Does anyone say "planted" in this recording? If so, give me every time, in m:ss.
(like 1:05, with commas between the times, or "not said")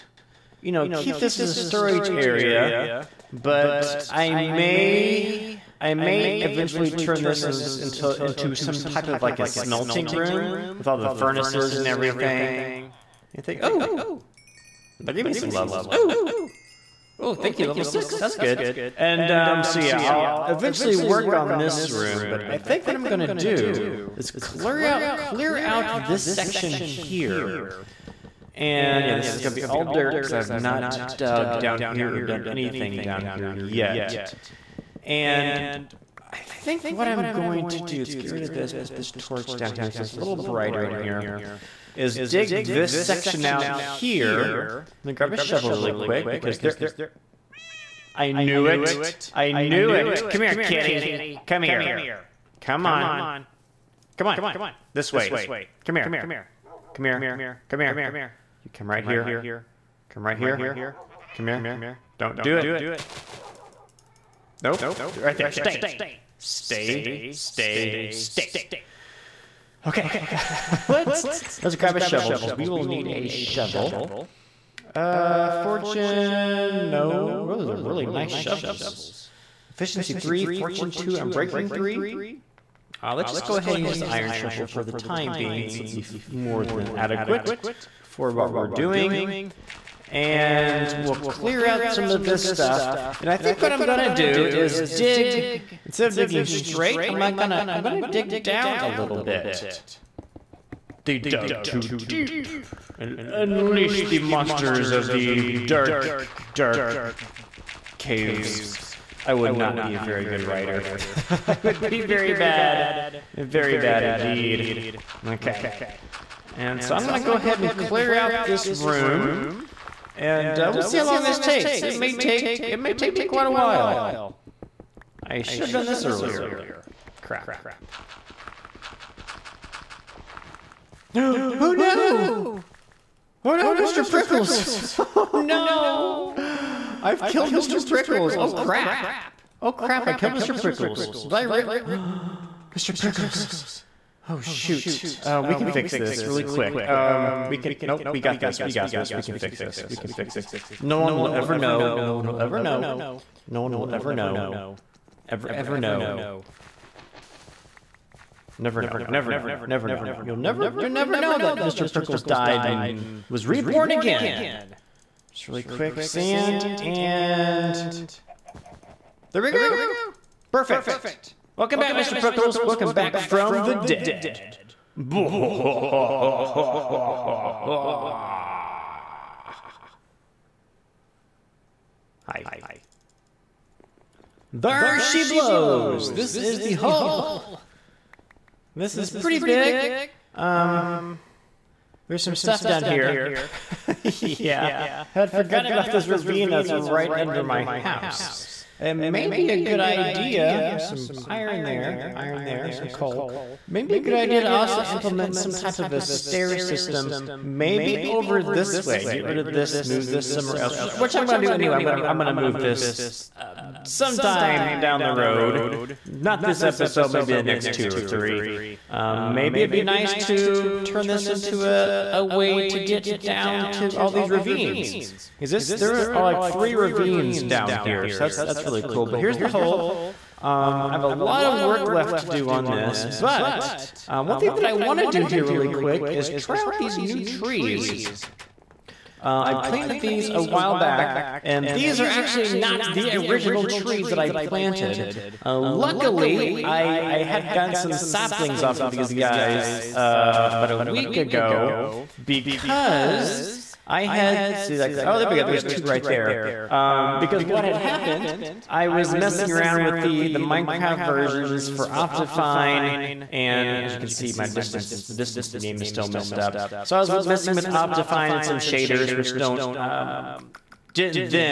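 3:59, 4:04.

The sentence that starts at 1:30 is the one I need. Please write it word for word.
And we'll clear out some of this stuff.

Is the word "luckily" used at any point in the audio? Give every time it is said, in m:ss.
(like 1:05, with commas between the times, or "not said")
4:05.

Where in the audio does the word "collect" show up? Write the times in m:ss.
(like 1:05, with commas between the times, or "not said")
not said.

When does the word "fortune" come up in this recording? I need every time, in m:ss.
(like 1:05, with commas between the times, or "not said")
1:15, 1:20.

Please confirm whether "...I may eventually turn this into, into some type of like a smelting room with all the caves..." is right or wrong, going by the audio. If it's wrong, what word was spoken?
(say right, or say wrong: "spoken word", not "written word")
wrong: "furnaces", not "caves".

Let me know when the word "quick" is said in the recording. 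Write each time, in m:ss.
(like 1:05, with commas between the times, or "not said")
0:45, 2:26, 2:45, 3:55.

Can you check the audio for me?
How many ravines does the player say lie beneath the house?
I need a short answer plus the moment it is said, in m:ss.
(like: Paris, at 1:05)
3, at 3:46.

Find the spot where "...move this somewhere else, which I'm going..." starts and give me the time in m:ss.
3:29.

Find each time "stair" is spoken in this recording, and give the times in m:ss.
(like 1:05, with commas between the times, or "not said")
3:25.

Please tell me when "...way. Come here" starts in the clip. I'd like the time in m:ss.
0:55.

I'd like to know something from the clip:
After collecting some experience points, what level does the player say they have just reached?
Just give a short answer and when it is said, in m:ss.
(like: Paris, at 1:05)
6, at 0:17.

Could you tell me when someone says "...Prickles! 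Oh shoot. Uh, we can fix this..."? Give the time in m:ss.
2:22.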